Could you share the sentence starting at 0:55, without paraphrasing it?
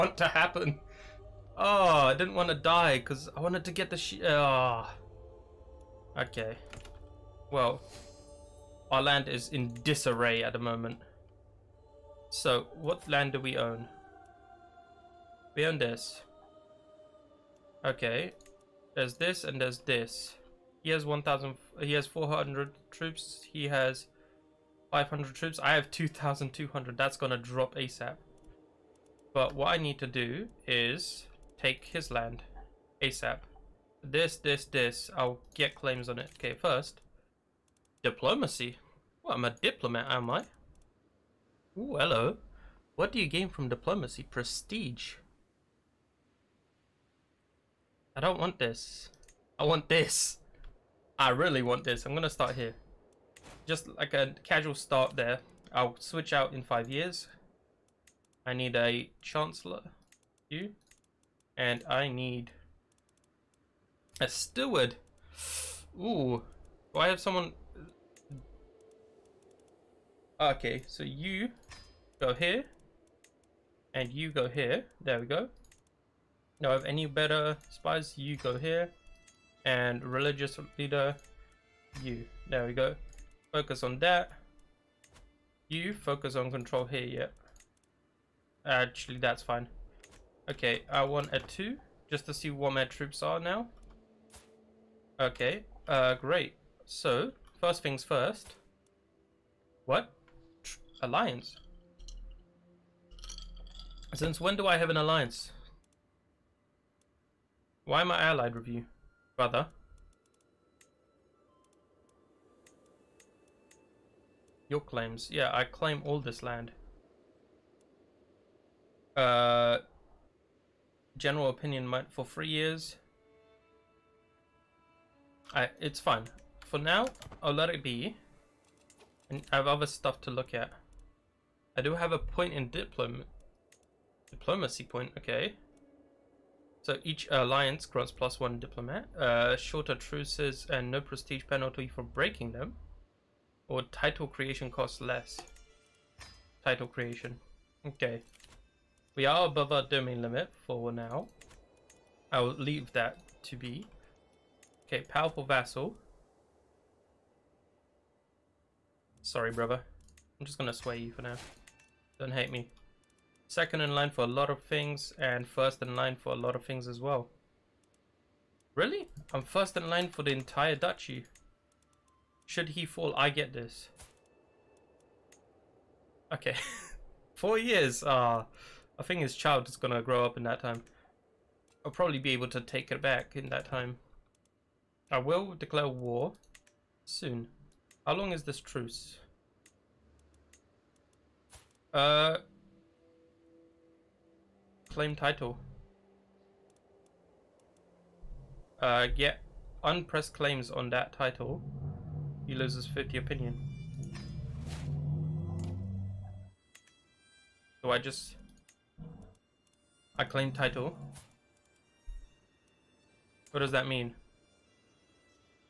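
I'll switch out in five years.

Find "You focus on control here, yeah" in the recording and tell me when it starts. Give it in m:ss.
1:25.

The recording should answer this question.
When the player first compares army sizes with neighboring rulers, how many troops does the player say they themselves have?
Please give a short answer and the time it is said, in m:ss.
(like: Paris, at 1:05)
2,200, at 0:25.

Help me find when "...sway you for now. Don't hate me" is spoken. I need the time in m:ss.
2:40.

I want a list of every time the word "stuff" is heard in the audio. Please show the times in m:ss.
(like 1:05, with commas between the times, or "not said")
2:09.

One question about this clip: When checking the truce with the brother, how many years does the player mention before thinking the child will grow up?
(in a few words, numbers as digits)
4.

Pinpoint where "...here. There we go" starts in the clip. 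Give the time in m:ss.
1:14.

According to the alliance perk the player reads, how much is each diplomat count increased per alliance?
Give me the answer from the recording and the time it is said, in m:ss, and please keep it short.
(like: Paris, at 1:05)
plus one, at 2:18.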